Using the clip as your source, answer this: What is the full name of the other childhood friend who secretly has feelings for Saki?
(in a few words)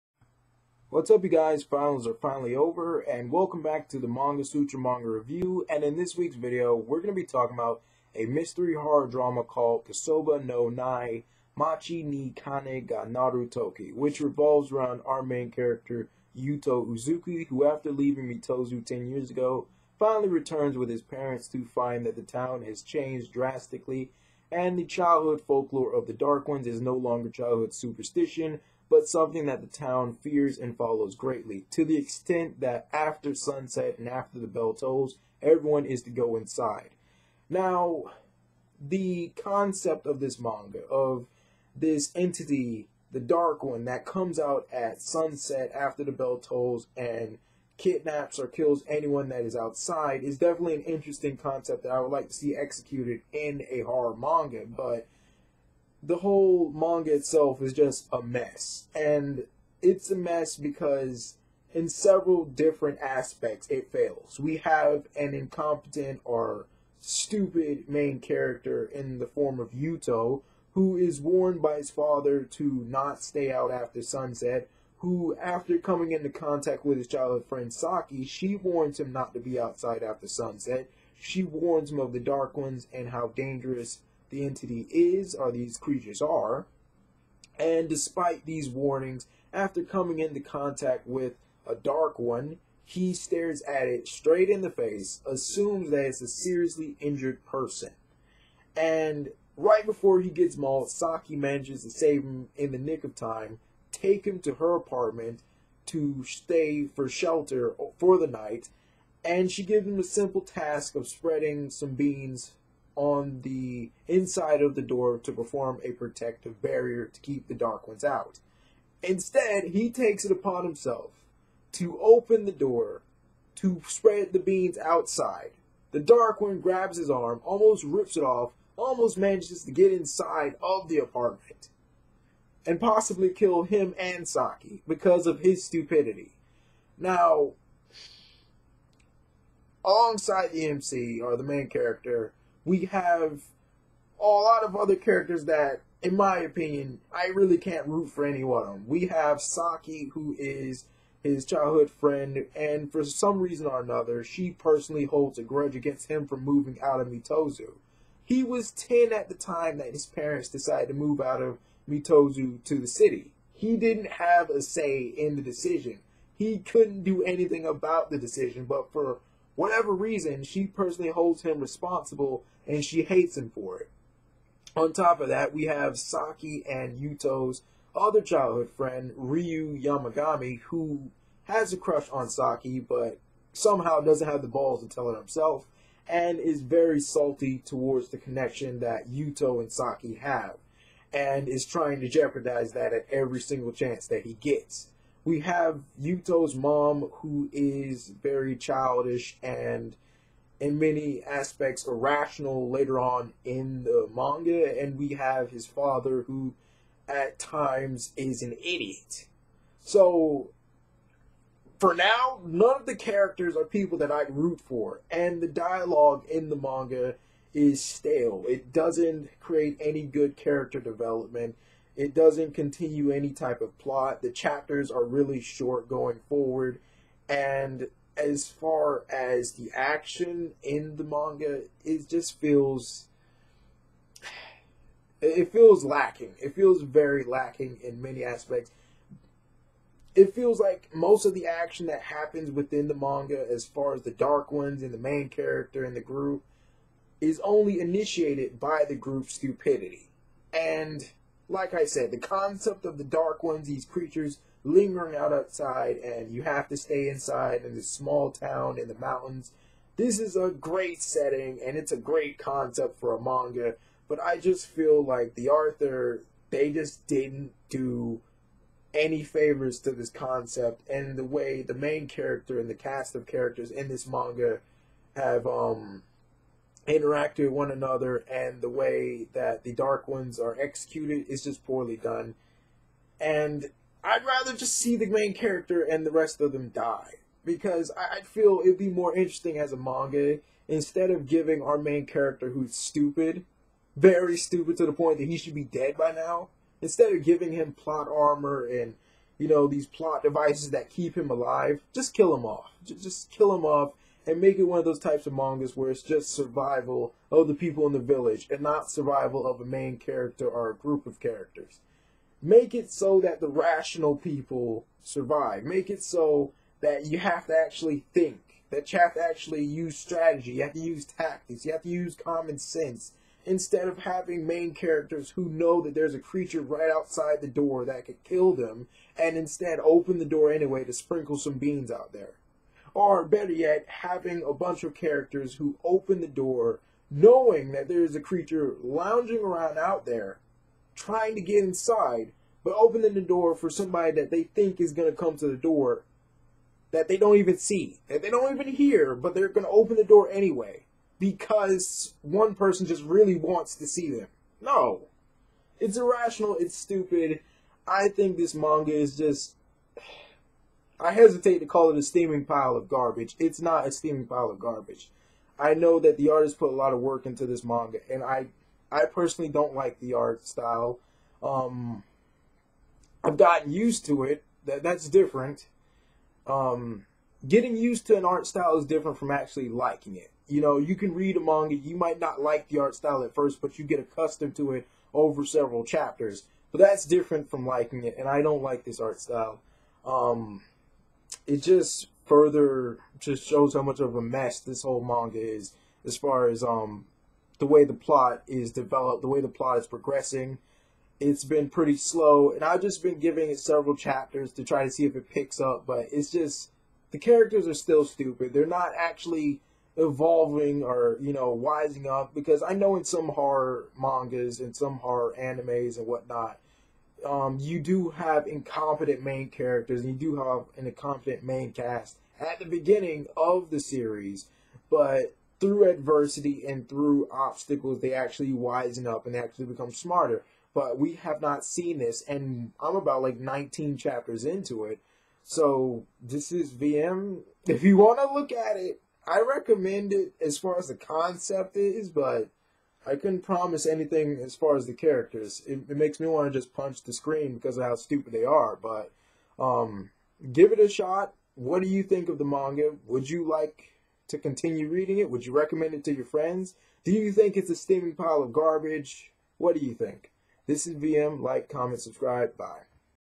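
Ryu Yamagami.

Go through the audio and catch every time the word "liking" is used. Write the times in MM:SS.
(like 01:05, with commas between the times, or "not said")
06:19, 06:27.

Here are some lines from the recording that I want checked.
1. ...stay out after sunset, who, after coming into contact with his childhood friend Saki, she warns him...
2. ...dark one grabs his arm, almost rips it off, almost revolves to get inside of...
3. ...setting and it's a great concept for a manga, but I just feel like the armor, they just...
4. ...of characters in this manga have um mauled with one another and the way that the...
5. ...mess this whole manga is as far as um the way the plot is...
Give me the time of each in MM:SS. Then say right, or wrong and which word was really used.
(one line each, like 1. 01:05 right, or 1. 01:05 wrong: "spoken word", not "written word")
1. 01:13 right
2. 02:05 wrong: "manages", not "revolves"
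3. 04:21 wrong: "author", not "armor"
4. 04:33 wrong: "interacted", not "mauled"
5. 06:34 right.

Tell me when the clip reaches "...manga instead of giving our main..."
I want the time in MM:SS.
04:49.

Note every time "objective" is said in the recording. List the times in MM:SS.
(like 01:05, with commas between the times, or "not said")
not said.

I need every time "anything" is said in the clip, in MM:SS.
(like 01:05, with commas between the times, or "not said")
02:47, 07:23.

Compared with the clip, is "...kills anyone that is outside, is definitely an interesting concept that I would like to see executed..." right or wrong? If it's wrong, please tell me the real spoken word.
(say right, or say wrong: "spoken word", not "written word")
right.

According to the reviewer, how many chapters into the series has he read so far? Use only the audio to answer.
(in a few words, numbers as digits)
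19.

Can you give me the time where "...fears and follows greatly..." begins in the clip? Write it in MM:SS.
00:30.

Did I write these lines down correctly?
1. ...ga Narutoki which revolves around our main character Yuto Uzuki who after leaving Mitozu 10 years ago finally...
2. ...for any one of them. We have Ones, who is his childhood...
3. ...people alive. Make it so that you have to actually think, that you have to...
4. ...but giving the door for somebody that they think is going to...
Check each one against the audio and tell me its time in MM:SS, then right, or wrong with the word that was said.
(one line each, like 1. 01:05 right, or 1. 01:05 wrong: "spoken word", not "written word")
1. 00:12 right
2. 02:28 wrong: "Saki", not "Ones"
3. 05:14 wrong: "survive", not "alive"
4. 05:42 wrong: "opening", not "giving".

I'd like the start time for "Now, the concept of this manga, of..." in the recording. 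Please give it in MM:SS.
00:37.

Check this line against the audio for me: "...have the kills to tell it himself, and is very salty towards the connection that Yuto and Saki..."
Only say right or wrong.
wrong.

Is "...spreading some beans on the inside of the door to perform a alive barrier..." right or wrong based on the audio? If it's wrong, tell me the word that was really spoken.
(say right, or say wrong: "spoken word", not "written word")
wrong: "protective", not "alive".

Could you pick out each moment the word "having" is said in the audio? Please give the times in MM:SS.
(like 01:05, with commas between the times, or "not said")
05:23, 05:33.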